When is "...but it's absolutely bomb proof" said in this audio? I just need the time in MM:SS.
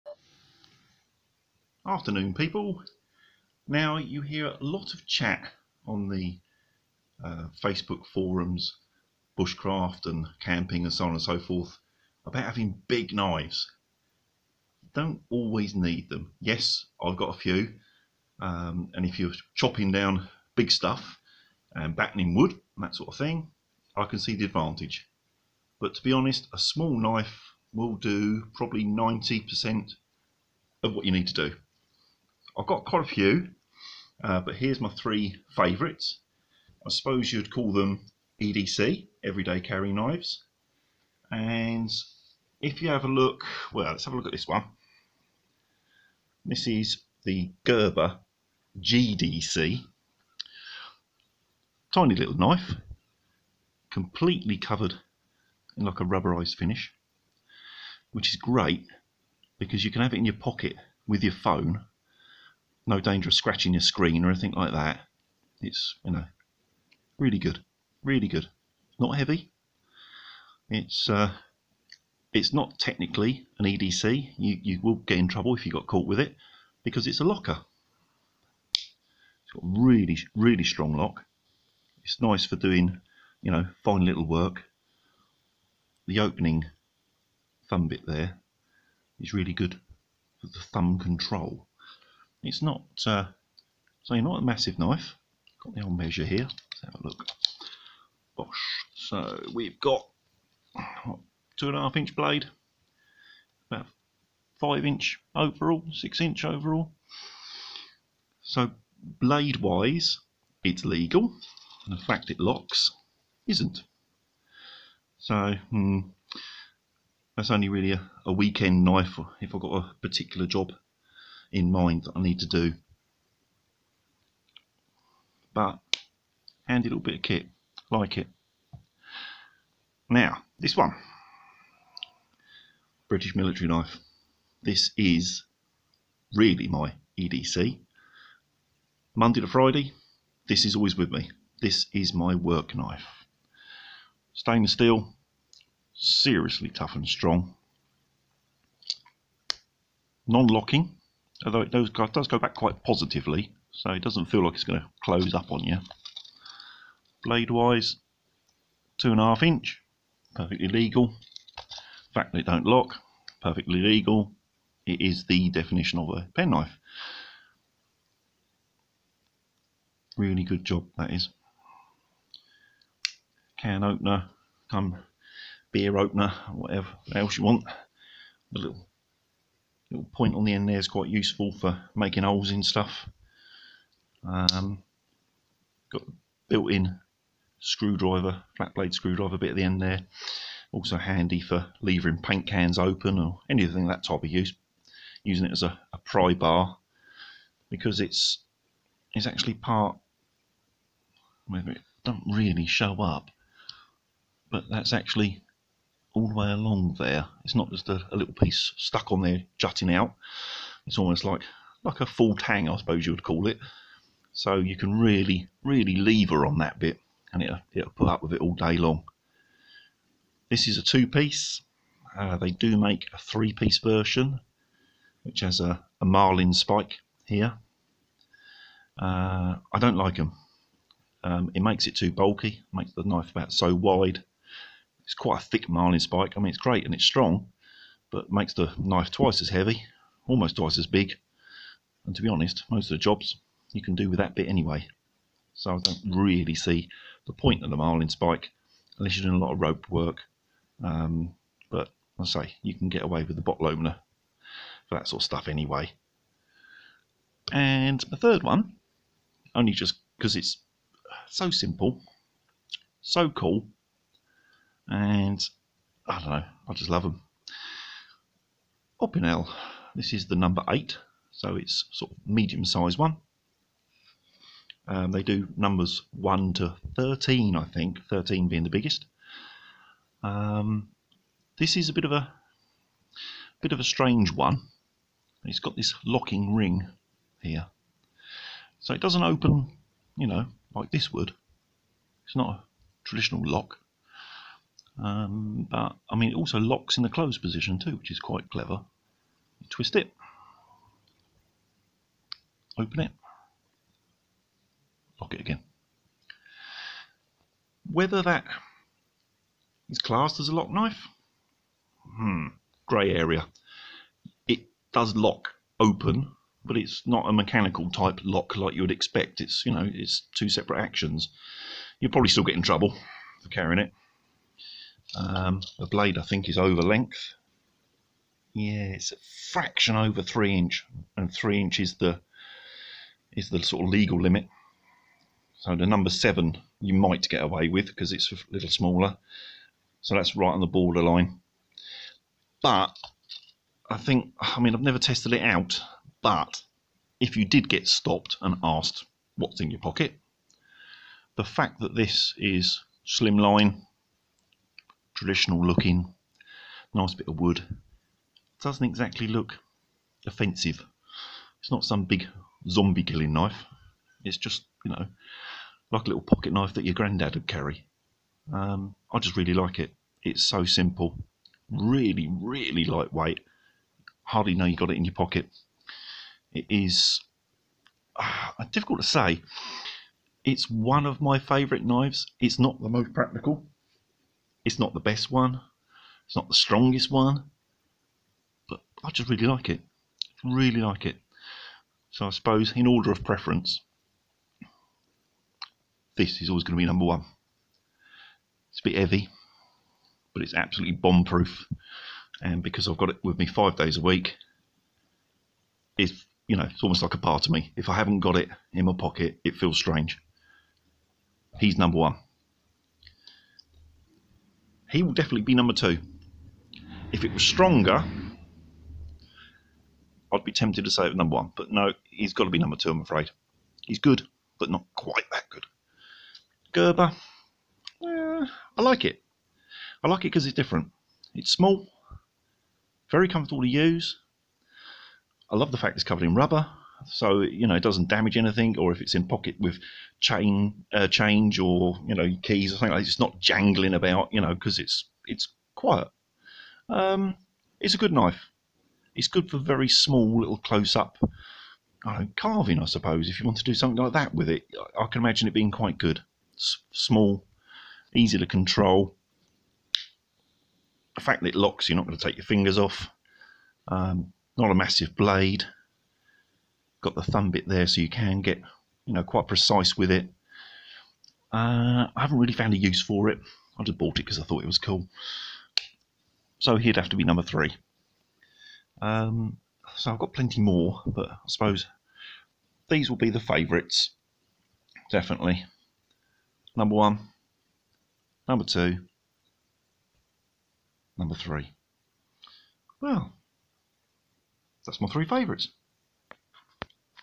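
06:40.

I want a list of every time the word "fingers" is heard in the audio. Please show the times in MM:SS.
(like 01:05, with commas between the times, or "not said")
07:42.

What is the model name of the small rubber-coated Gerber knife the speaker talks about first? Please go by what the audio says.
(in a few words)
GDC.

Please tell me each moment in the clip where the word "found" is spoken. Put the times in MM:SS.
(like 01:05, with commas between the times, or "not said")
07:52.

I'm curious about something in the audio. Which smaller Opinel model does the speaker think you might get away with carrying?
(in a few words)
Number 7.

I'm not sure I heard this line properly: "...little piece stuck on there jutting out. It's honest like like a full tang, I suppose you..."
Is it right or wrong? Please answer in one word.
wrong.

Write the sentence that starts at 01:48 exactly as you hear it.
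So blade wise, it's legal, and the fact it locks isn't.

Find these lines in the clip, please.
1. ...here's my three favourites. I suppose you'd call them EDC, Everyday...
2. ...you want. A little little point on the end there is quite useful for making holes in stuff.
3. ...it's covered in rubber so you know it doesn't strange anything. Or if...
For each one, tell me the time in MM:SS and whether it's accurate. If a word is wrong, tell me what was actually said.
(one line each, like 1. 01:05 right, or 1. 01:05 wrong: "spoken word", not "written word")
1. 00:34 right
2. 02:57 right
3. 07:15 wrong: "damage", not "strange".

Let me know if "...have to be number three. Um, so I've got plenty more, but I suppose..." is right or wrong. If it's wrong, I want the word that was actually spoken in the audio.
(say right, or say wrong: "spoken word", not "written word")
right.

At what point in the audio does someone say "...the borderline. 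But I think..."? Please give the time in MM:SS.
05:40.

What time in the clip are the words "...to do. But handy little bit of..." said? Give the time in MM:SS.
02:02.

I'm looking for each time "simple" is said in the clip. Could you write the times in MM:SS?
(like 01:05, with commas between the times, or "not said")
04:21, 06:10.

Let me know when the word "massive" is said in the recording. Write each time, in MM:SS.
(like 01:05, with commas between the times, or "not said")
01:34, 07:44.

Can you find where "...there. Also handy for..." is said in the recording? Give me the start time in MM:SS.
03:09.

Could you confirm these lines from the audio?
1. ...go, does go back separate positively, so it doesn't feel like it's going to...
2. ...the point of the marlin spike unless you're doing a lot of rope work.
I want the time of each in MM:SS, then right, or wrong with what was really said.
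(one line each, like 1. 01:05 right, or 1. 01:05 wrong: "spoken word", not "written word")
1. 02:31 wrong: "quite", not "separate"
2. 04:07 right.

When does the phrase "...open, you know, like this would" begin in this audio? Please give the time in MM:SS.
04:49.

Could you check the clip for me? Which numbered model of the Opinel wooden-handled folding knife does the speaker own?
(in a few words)
Number 8.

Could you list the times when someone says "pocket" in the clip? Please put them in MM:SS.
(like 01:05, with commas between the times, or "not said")
01:00, 05:49, 06:06, 06:15, 06:48, 07:19.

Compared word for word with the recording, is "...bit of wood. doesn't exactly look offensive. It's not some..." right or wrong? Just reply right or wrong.
right.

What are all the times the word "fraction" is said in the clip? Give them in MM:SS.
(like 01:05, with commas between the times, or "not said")
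05:29.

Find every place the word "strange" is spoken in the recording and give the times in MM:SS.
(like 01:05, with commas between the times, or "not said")
04:43, 06:49.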